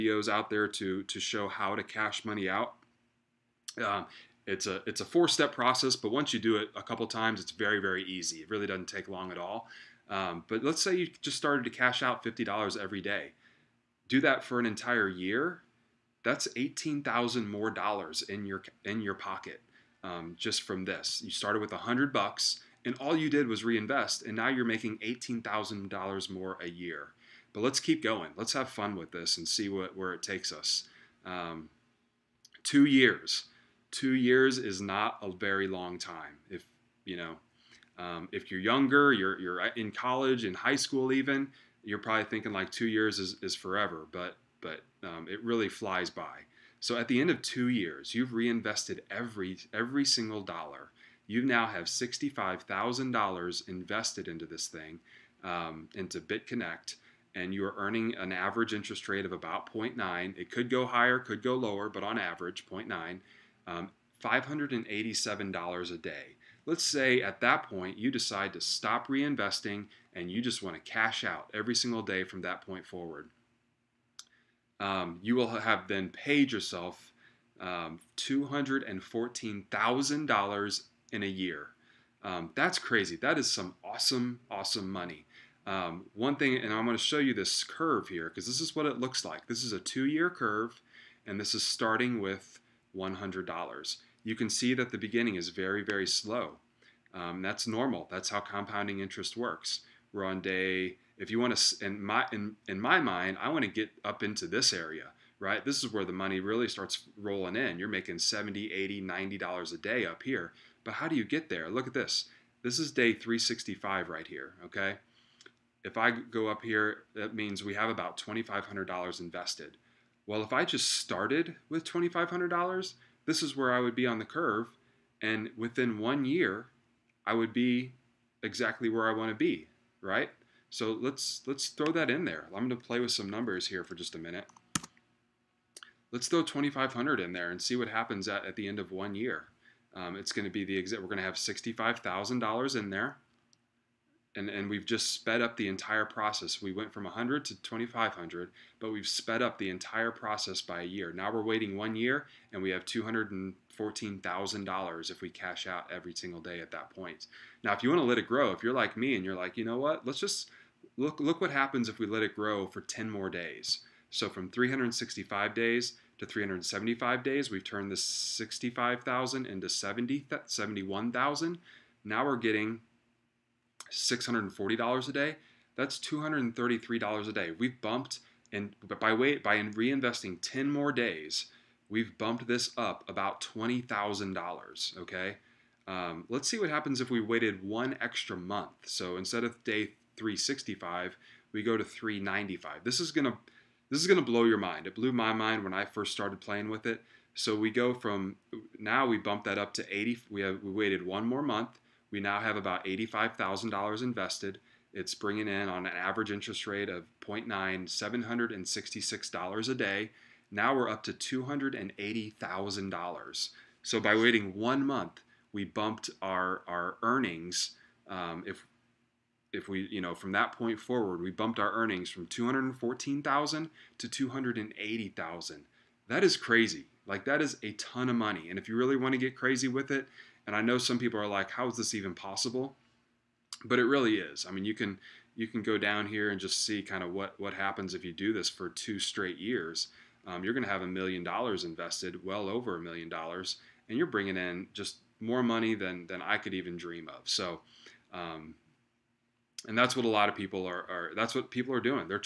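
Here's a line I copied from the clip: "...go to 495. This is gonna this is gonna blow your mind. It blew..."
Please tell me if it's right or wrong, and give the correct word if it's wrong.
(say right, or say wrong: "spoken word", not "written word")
wrong: "395", not "495".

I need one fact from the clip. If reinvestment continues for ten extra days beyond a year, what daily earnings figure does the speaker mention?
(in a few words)
$640.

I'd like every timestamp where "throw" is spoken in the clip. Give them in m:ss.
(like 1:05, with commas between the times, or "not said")
2:11, 2:16.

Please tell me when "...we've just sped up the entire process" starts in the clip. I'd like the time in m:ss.
2:24.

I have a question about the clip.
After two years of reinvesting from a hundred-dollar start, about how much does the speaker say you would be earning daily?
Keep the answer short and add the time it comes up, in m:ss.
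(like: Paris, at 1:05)
$587, at 1:04.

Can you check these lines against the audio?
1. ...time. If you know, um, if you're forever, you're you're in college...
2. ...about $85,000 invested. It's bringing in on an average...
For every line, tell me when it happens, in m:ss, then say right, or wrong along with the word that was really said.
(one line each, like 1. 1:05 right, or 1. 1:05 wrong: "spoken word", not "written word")
1. 0:35 wrong: "younger", not "forever"
2. 3:22 right.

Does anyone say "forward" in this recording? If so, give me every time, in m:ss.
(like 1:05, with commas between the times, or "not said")
1:12, 3:40.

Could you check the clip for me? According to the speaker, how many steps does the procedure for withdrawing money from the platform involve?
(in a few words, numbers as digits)
4.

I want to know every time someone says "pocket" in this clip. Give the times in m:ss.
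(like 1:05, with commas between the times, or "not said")
0:19.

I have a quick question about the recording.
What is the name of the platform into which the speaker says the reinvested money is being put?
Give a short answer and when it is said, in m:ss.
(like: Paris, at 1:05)
BitConnect, at 0:56.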